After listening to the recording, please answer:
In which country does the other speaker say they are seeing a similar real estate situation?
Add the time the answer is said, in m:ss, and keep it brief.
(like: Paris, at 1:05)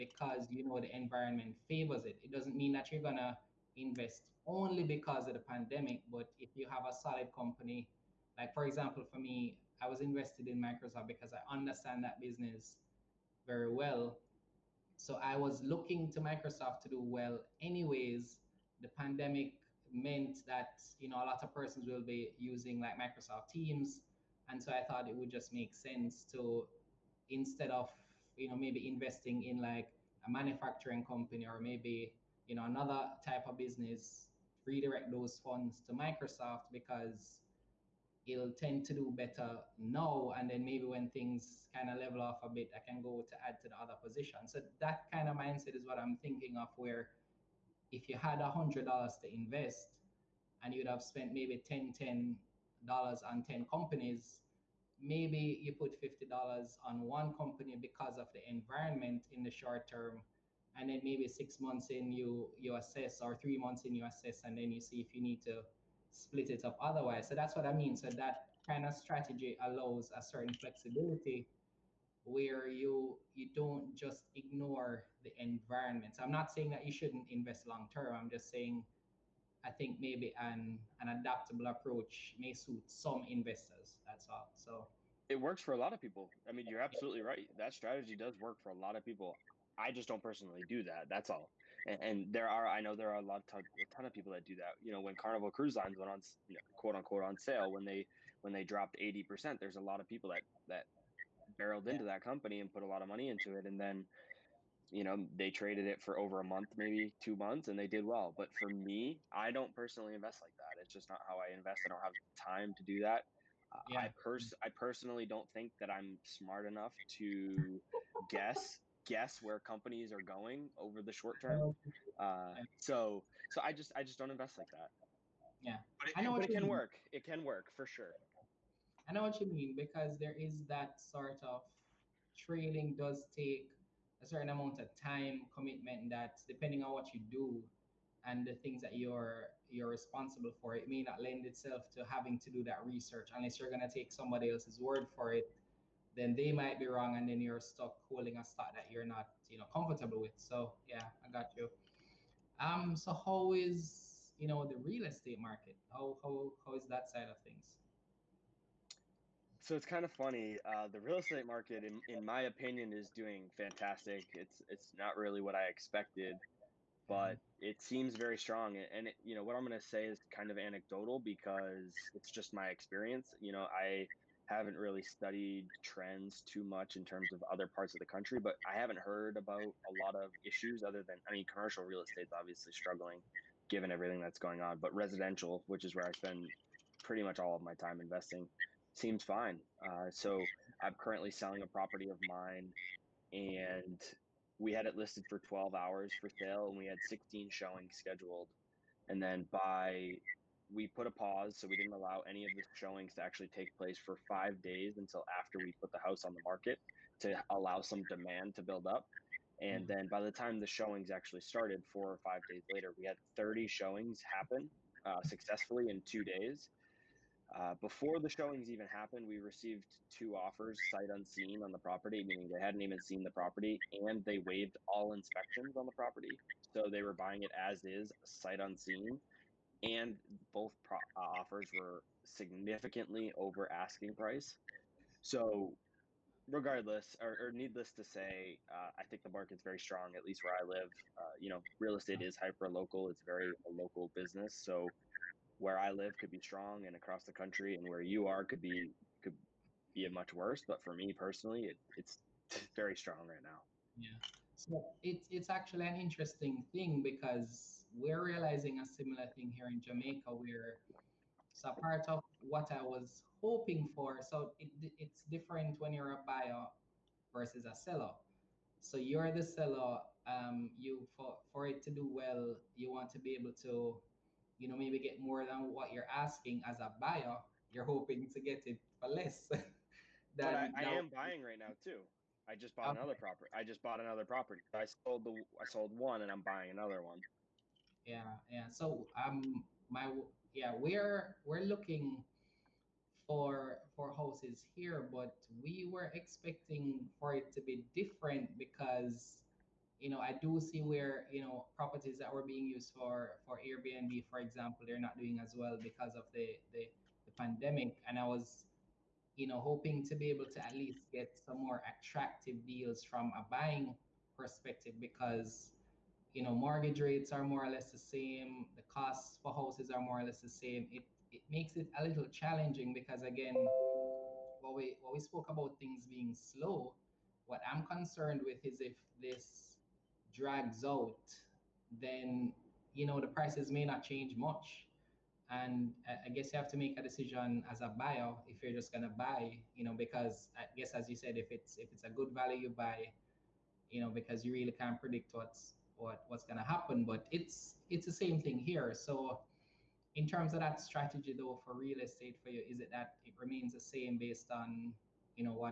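Jamaica, at 4:19.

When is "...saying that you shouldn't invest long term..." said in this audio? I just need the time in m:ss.
1:16.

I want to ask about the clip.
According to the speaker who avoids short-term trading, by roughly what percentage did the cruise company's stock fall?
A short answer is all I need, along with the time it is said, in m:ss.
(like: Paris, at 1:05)
80%, at 1:38.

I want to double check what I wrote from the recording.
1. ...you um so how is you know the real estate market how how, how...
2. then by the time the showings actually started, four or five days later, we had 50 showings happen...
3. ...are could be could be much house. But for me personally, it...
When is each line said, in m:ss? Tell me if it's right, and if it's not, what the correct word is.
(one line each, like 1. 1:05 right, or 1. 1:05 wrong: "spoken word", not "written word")
1. 2:31 right
2. 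3:29 wrong: "30", not "50"
3. 4:08 wrong: "worse", not "house".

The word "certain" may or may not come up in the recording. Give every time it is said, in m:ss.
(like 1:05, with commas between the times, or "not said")
1:10, 2:14.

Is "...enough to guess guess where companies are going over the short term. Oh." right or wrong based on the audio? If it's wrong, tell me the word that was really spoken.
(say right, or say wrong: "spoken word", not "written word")
right.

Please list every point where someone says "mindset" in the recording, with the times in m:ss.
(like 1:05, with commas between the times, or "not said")
0:45.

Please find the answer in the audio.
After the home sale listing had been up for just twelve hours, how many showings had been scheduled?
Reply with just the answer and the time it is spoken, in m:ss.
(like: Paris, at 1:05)
16, at 3:17.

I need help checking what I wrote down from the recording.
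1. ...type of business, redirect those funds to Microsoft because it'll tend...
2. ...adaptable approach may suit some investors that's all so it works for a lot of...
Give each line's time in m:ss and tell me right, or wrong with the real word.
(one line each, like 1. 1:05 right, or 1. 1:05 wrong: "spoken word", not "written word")
1. 0:33 right
2. 1:21 right.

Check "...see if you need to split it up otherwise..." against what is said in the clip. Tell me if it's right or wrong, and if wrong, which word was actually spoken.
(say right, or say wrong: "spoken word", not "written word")
right.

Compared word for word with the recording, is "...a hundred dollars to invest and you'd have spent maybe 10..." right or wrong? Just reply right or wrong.
right.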